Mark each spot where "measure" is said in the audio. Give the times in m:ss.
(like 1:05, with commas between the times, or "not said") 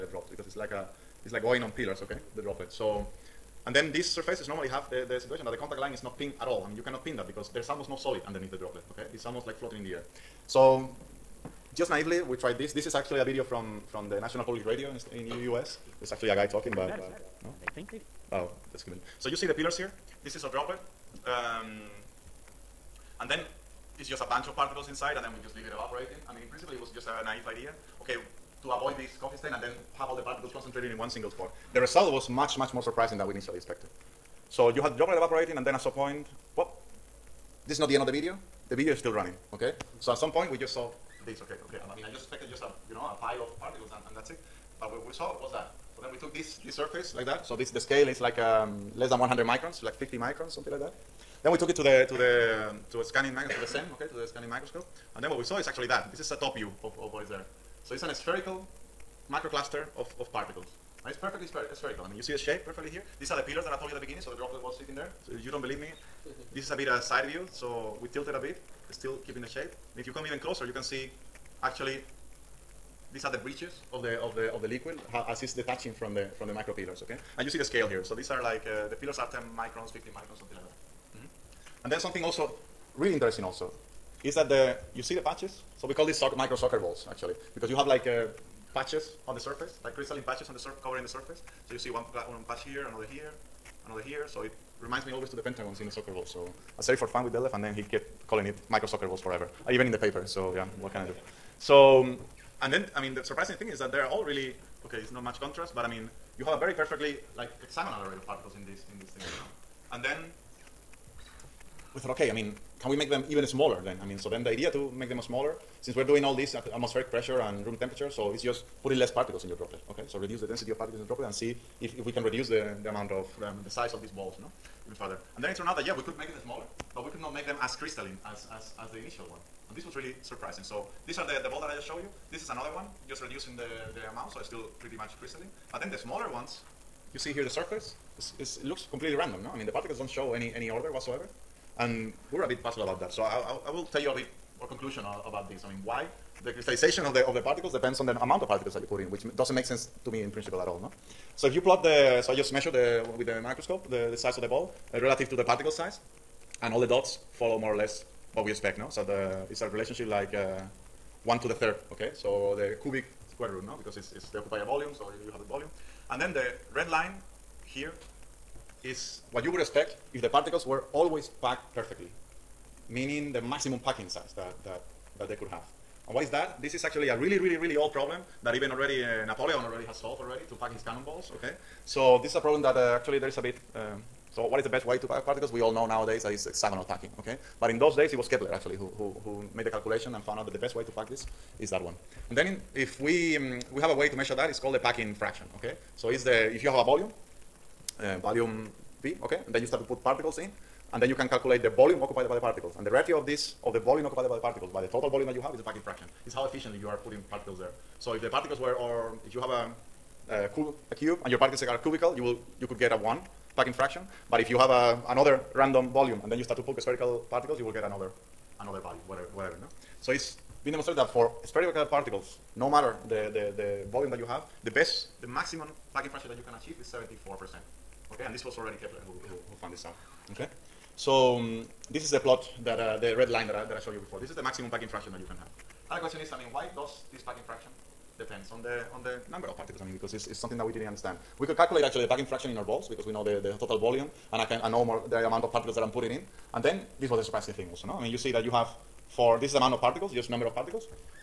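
2:32, 3:14.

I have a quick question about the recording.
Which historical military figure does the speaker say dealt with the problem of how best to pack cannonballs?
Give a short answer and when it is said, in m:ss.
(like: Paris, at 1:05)
Napoleon, at 2:59.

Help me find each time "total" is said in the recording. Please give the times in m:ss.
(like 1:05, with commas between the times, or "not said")
3:24, 4:03.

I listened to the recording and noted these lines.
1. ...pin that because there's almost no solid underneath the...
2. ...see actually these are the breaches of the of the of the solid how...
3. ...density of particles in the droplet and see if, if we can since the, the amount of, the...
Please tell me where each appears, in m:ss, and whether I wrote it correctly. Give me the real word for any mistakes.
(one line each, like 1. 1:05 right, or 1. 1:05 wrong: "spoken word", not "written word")
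1. 0:07 right
2. 1:10 wrong: "liquid", not "solid"
3. 2:00 wrong: "reduce", not "since".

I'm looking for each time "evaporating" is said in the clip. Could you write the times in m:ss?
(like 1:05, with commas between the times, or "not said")
0:25, 0:35.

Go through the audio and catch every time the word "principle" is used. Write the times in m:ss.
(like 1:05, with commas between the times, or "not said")
0:26, 2:30.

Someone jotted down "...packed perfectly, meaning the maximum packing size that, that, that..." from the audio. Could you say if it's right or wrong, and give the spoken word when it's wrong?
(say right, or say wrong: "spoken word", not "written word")
right.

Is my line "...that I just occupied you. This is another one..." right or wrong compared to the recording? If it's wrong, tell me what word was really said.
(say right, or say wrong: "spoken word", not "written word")
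wrong: "showed", not "occupied".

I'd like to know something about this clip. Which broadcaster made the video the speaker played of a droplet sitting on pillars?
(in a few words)
National Public Radio.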